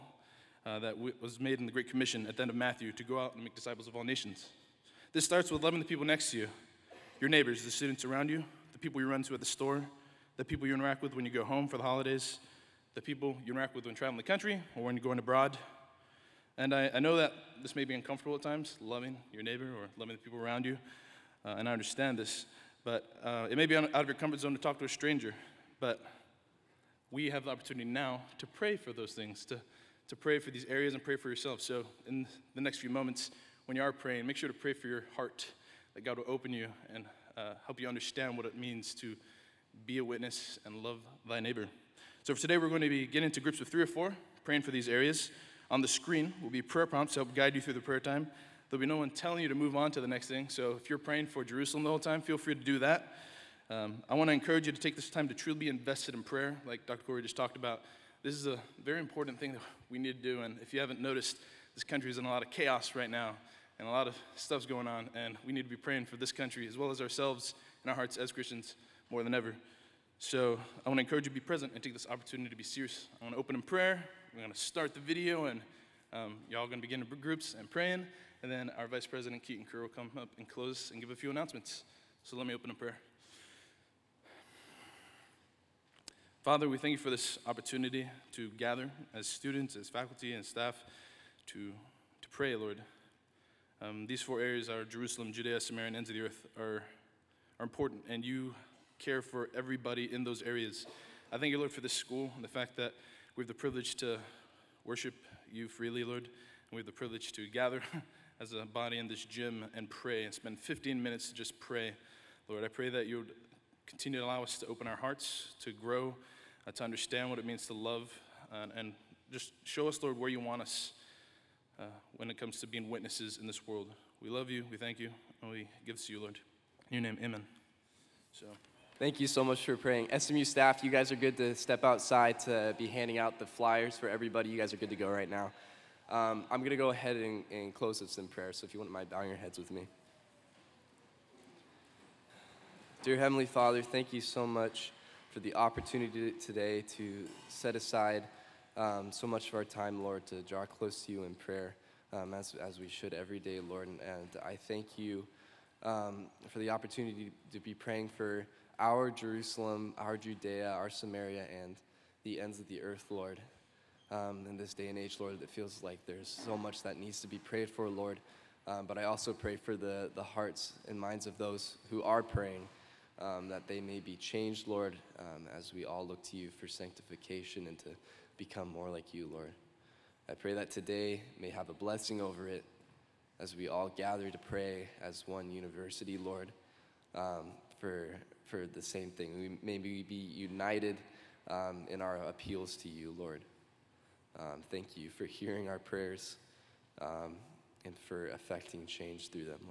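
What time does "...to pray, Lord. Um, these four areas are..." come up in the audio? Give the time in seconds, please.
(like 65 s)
92 s.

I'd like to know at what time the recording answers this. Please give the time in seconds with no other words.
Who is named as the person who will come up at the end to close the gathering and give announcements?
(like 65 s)
79 s.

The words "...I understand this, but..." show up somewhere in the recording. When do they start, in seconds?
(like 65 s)
21 s.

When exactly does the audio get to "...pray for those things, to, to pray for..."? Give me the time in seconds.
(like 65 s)
28 s.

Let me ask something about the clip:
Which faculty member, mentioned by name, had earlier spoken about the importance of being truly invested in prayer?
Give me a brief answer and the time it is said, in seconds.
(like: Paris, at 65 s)
Dr. Corey, at 56 s.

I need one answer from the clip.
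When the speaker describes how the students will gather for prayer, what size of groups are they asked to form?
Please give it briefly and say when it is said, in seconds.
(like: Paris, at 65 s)
3 or 4, at 43 s.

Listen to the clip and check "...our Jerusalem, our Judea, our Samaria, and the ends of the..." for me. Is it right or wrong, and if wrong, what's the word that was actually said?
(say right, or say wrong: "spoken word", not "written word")
right.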